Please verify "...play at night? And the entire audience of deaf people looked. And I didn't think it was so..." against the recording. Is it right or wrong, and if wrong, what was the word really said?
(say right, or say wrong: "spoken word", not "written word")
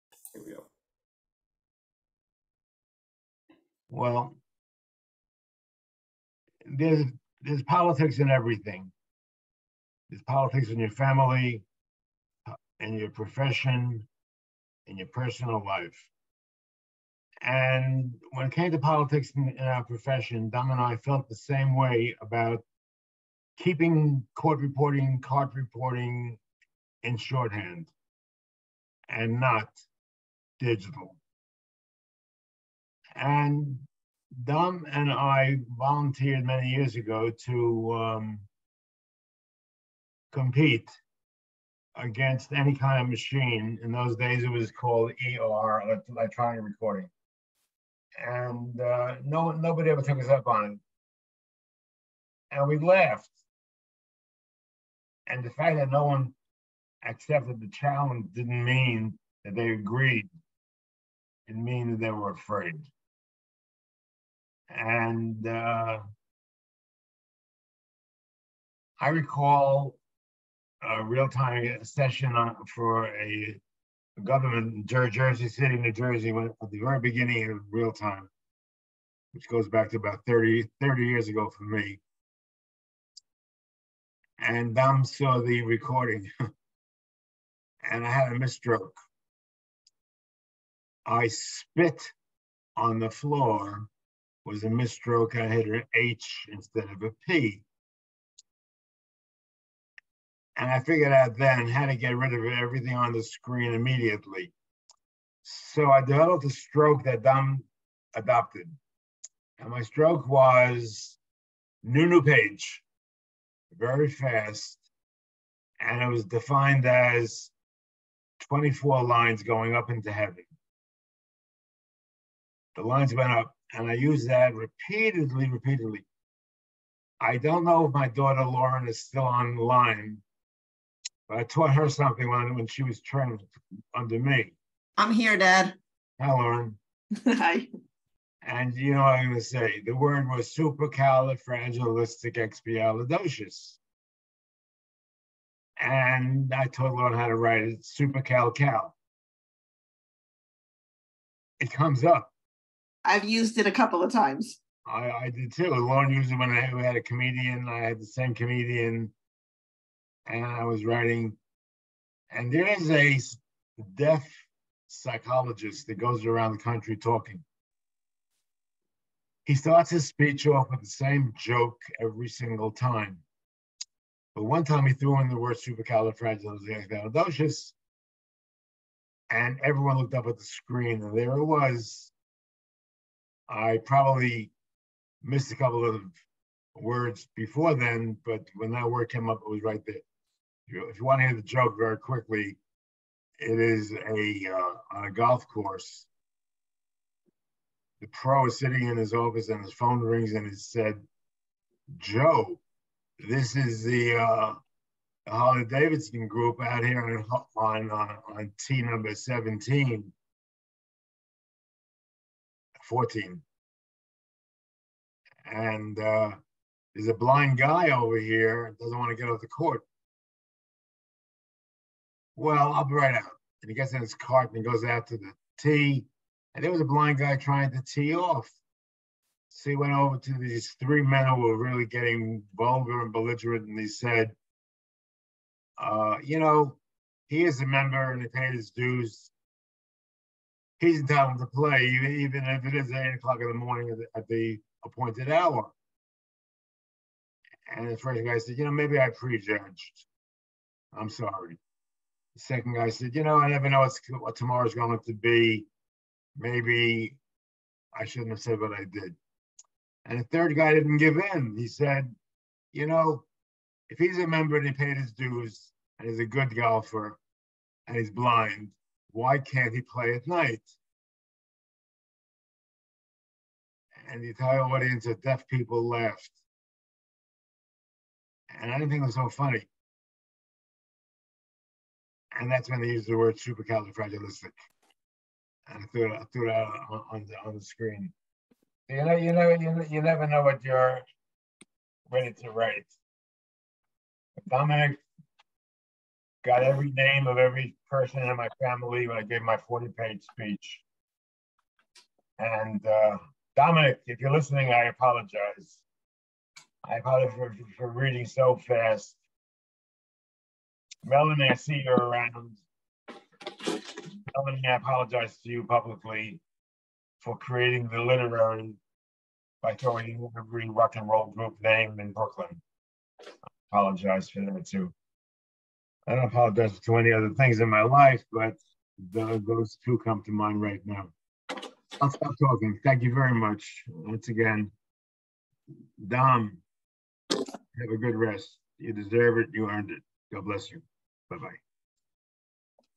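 wrong: "laughed", not "looked".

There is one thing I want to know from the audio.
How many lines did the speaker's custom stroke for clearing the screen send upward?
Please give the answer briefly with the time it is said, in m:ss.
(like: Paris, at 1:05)
24, at 1:58.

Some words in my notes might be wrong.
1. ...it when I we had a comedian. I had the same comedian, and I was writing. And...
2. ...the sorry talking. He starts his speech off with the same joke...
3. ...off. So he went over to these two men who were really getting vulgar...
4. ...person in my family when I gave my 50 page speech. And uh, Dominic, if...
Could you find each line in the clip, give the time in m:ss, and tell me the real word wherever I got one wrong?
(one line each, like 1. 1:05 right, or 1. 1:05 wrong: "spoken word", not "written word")
1. 2:36 right
2. 2:46 wrong: "country", not "sorry"
3. 3:48 wrong: "three", not "two"
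4. 4:57 wrong: "40", not "50".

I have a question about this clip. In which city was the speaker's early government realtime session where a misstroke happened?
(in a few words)
Jersey City.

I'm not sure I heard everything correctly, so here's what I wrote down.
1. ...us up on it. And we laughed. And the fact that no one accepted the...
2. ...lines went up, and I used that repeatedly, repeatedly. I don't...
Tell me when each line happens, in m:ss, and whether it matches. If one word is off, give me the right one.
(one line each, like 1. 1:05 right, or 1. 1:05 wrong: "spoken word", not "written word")
1. 0:50 right
2. 2:02 right.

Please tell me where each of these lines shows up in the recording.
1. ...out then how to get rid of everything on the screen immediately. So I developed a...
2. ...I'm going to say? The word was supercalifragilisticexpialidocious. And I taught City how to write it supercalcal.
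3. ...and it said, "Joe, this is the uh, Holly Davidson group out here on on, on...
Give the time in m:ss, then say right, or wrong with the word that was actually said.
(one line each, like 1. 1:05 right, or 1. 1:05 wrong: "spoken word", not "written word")
1. 1:41 right
2. 2:19 wrong: "Lauren", not "City"
3. 3:20 right.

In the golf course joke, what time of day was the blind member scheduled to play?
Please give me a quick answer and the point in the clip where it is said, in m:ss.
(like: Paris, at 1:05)
eight o'clock in the morning, at 4:02.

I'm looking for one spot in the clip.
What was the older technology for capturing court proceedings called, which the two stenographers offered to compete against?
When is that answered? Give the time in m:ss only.
0:46.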